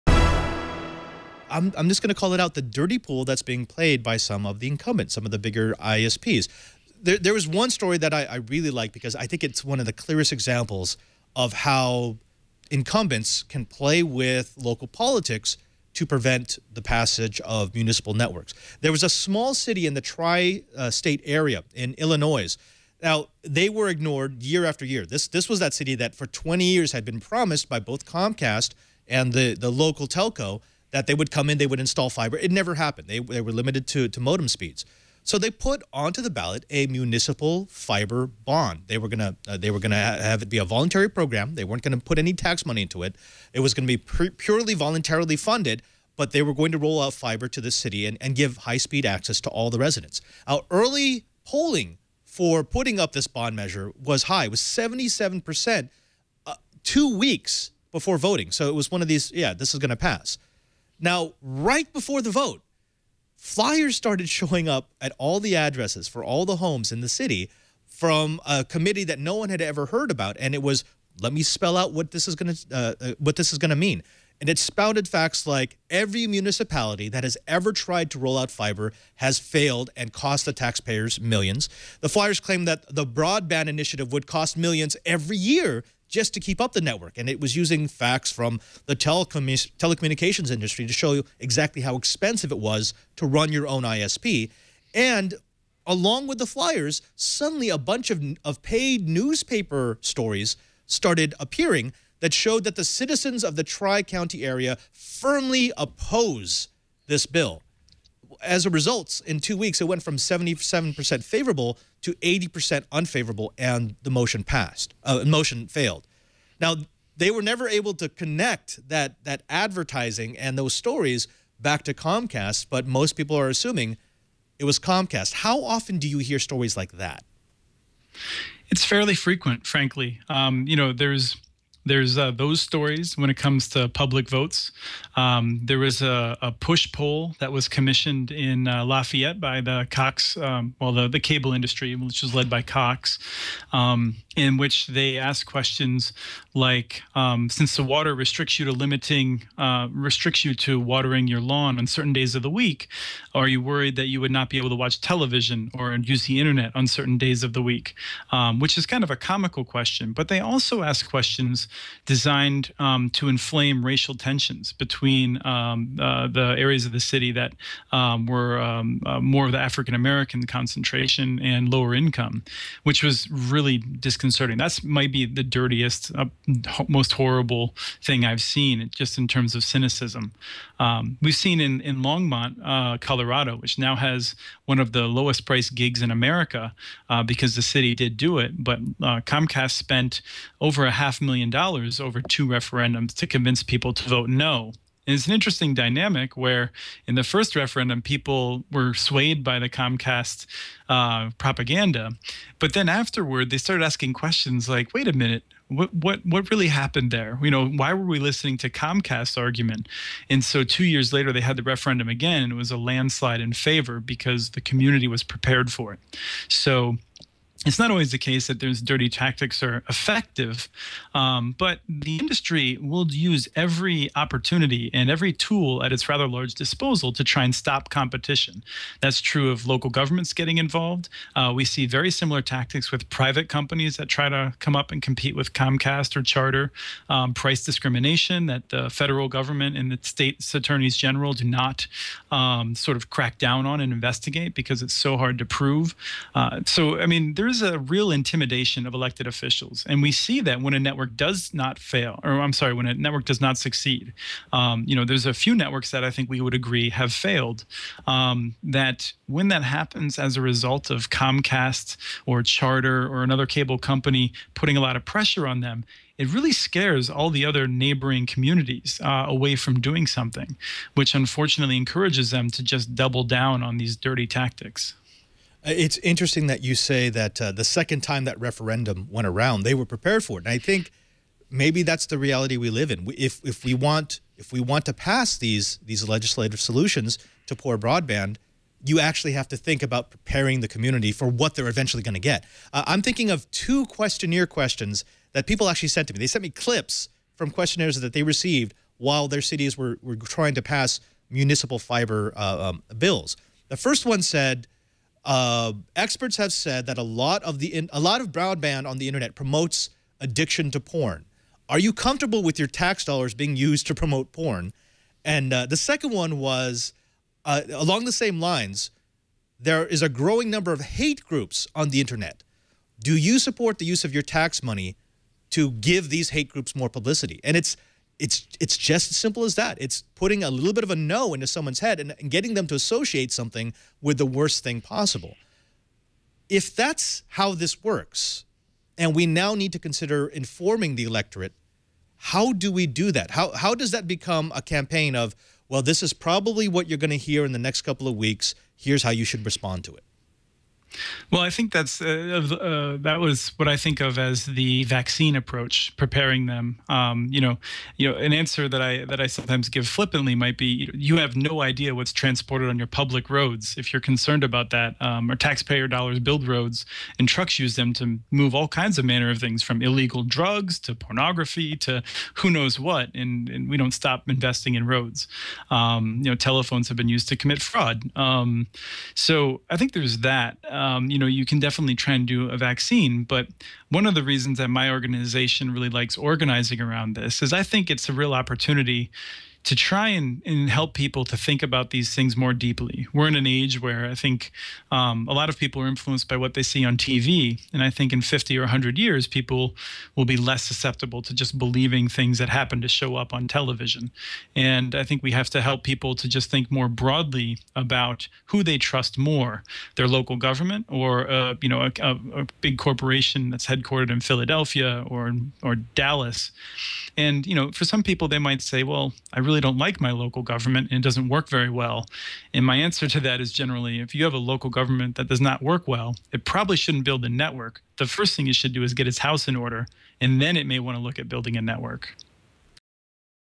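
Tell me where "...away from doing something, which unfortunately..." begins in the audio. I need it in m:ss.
4:29.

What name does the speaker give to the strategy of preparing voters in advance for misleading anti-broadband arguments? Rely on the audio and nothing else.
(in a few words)
vaccine approach.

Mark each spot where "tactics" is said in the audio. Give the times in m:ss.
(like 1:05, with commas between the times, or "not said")
3:39, 3:52, 4:34.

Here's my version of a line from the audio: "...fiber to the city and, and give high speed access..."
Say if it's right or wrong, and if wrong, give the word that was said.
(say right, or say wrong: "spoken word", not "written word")
right.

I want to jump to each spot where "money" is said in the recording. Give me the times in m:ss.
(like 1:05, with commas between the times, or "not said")
0:42, 5:24.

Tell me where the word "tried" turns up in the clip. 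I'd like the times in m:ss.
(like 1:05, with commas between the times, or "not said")
1:17.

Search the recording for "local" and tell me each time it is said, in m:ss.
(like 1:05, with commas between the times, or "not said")
0:14, 0:29, 3:49, 6:50, 7:00, 7:04.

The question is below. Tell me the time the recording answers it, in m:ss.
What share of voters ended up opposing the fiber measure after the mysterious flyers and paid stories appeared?
1:52.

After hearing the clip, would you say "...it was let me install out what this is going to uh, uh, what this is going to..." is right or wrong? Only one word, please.
wrong.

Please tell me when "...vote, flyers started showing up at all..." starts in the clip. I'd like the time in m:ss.
1:02.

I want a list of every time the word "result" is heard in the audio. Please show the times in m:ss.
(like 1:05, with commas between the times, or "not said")
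1:48, 4:20.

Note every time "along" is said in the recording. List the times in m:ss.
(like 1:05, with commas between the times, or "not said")
1:35, 5:17.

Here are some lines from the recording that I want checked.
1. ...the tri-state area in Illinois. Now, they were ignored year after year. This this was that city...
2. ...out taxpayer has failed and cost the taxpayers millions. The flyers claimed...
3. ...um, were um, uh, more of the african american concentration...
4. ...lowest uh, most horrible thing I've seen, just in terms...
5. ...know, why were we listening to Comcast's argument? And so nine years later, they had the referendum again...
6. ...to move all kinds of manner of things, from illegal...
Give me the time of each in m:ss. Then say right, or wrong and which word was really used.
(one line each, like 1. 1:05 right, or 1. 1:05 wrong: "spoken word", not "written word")
1. 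0:19 right
2. 1:18 wrong: "fiber", not "taxpayer"
3. 2:47 right
4. 2:55 wrong: "dirtiest", not "lowest"
5. 3:27 wrong: "two", not "nine"
6. 6:07 right.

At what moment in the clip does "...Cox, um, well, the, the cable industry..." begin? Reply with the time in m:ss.
2:19.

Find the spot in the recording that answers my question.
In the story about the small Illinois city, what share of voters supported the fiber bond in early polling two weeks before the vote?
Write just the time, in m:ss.
0:54.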